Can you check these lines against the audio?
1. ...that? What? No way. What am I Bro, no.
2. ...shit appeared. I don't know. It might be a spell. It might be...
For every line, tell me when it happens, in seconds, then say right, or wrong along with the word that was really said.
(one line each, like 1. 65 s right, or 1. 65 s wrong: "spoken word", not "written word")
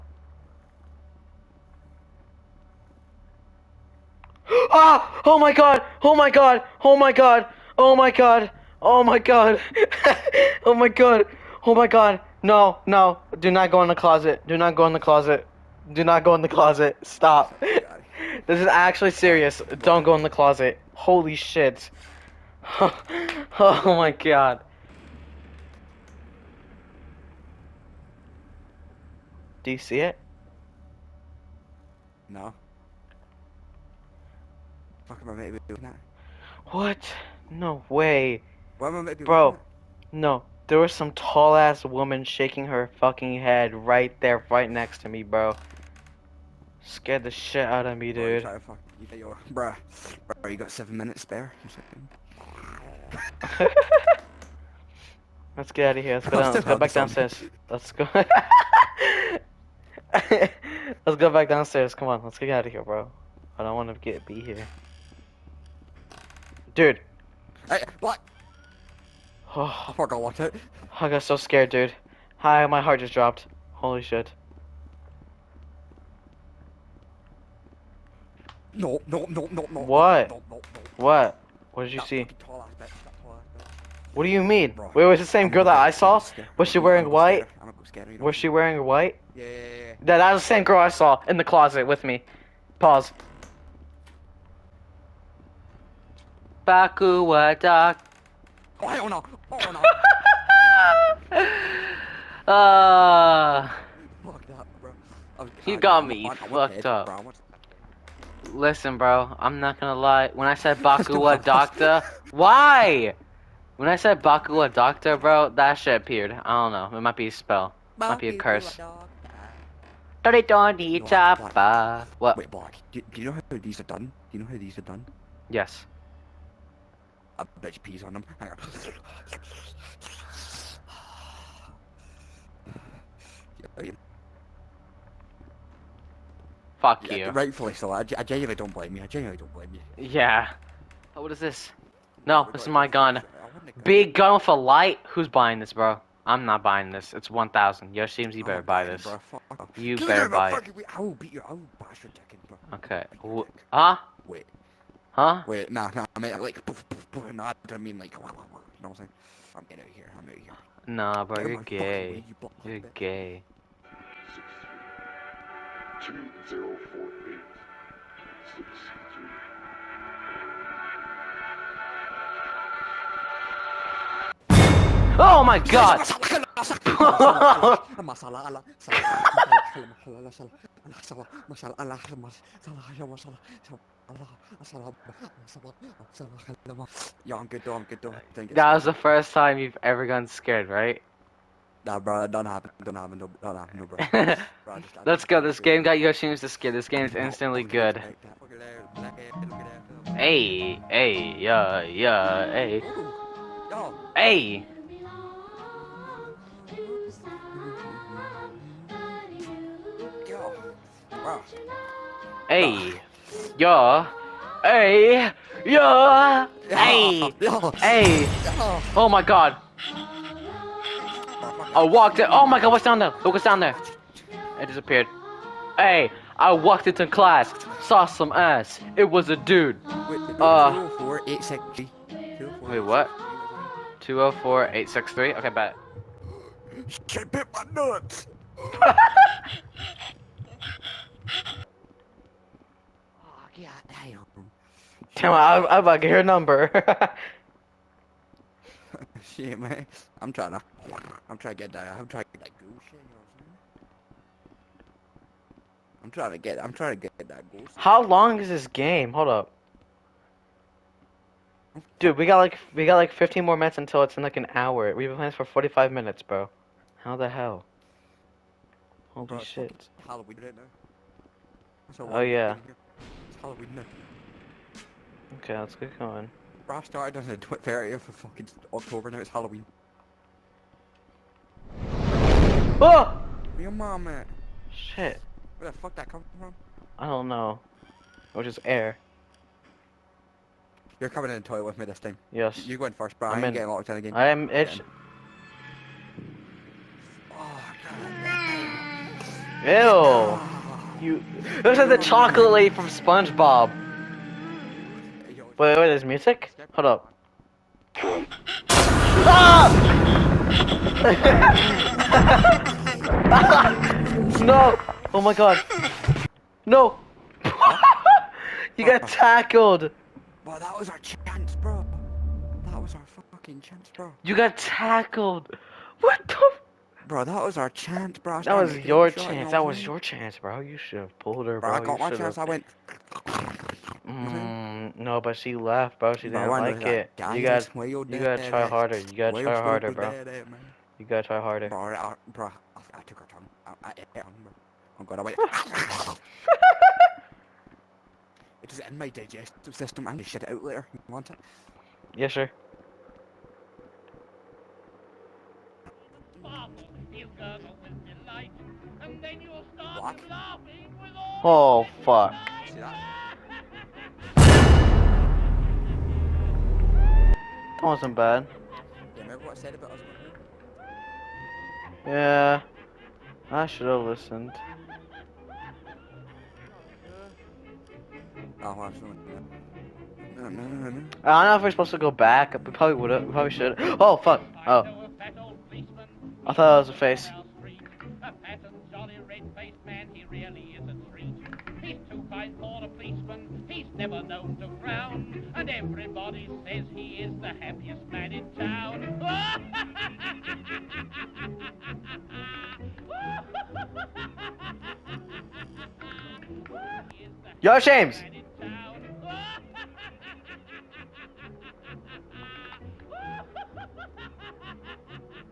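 1. 35 s right
2. 115 s right.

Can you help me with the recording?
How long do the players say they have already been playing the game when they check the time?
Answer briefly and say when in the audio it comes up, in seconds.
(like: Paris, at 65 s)
45 minutes, at 265 s.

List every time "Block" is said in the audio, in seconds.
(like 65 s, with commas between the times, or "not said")
122 s.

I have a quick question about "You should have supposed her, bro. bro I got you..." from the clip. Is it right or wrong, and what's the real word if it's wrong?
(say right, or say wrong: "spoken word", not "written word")
wrong: "pulled", not "supposed".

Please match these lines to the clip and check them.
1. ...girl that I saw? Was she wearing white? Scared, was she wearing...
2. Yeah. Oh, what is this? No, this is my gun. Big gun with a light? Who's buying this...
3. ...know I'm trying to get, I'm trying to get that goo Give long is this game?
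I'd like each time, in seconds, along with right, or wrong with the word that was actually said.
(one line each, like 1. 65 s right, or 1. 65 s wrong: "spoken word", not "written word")
1. 85 s right
2. 140 s right
3. 252 s wrong: "How", not "Give".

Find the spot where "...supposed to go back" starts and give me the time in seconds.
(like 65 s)
381 s.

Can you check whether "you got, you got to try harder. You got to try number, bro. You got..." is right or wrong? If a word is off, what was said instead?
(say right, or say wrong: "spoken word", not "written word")
wrong: "harder", not "number".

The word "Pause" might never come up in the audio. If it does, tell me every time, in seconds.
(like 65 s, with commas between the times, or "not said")
92 s.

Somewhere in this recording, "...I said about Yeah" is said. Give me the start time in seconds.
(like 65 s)
369 s.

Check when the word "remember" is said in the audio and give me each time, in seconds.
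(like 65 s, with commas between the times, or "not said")
369 s.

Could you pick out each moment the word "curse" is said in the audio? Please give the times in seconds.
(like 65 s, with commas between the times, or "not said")
118 s.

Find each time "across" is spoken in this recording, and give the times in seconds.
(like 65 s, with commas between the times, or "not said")
not said.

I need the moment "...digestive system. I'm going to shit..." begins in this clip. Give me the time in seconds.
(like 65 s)
349 s.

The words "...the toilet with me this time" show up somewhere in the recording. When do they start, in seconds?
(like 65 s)
291 s.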